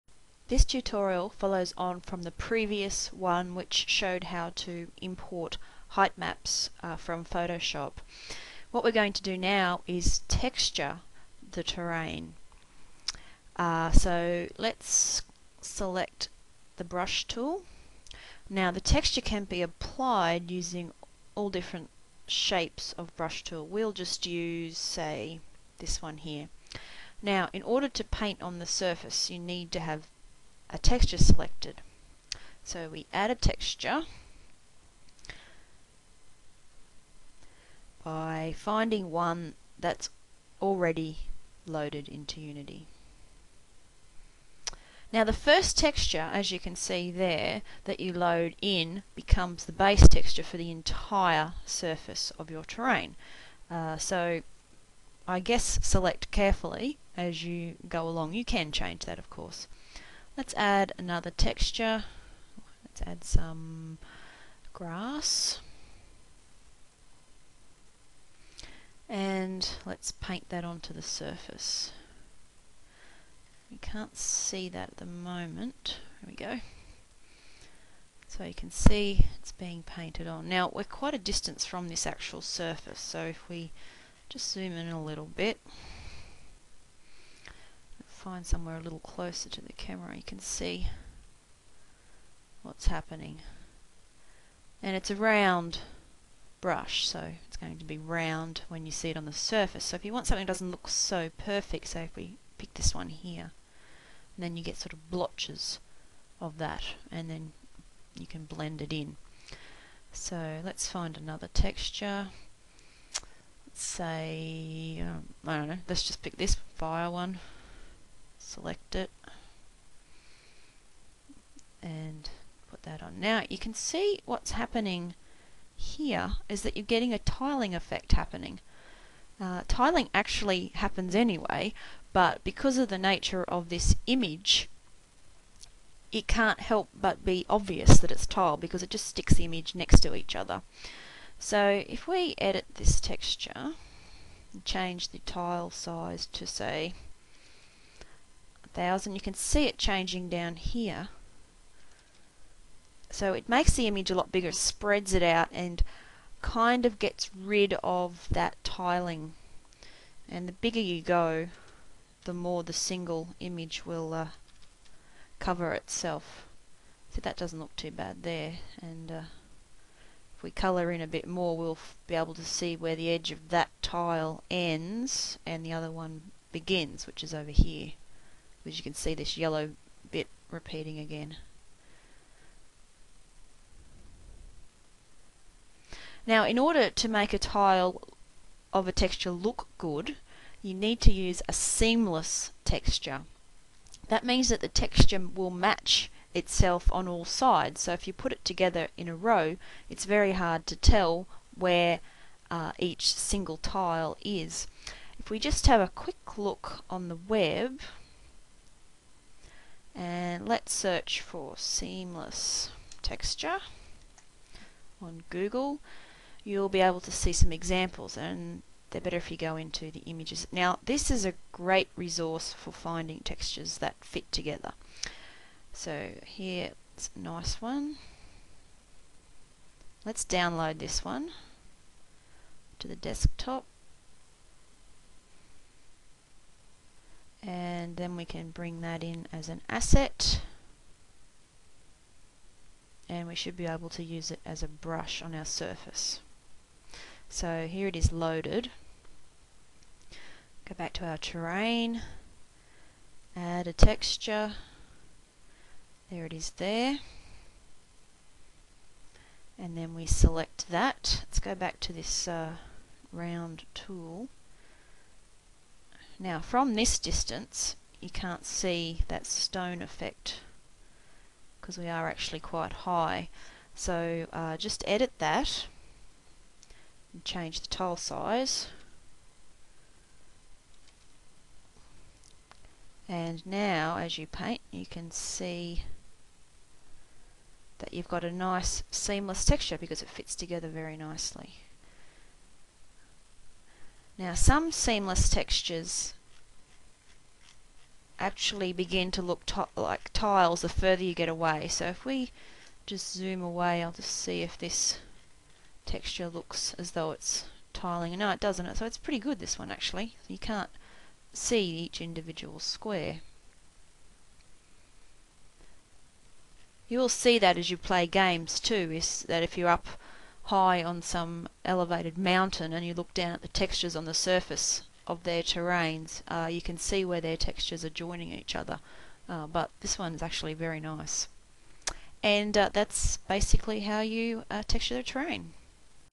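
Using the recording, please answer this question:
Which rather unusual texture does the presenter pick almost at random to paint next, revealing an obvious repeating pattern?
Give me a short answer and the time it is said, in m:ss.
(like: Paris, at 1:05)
fire, at 1:56.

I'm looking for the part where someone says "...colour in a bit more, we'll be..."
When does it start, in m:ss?
2:50.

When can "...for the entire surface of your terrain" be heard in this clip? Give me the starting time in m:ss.
0:50.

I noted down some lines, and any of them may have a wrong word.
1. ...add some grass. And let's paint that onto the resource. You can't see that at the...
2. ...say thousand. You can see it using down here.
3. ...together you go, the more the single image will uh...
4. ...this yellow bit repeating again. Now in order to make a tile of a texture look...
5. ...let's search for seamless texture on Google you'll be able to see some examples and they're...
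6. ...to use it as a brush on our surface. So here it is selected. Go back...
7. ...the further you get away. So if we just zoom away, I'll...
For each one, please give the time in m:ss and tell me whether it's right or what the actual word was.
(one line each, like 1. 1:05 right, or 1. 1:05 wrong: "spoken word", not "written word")
1. 1:03 wrong: "surface", not "resource"
2. 2:26 wrong: "changing", not "using"
3. 2:40 wrong: "bigger", not "together"
4. 2:59 right
5. 3:30 right
6. 4:03 wrong: "loaded", not "selected"
7. 5:00 right.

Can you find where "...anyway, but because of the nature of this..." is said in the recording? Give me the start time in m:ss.
2:11.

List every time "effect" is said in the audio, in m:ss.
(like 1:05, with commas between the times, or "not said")
2:07, 4:29.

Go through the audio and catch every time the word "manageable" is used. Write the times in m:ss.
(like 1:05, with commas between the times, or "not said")
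not said.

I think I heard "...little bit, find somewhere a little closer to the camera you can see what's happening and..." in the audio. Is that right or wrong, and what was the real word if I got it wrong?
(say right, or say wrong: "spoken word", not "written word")
right.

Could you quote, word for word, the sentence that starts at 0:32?
So we add a texture by finding one that's already loaded into Unity.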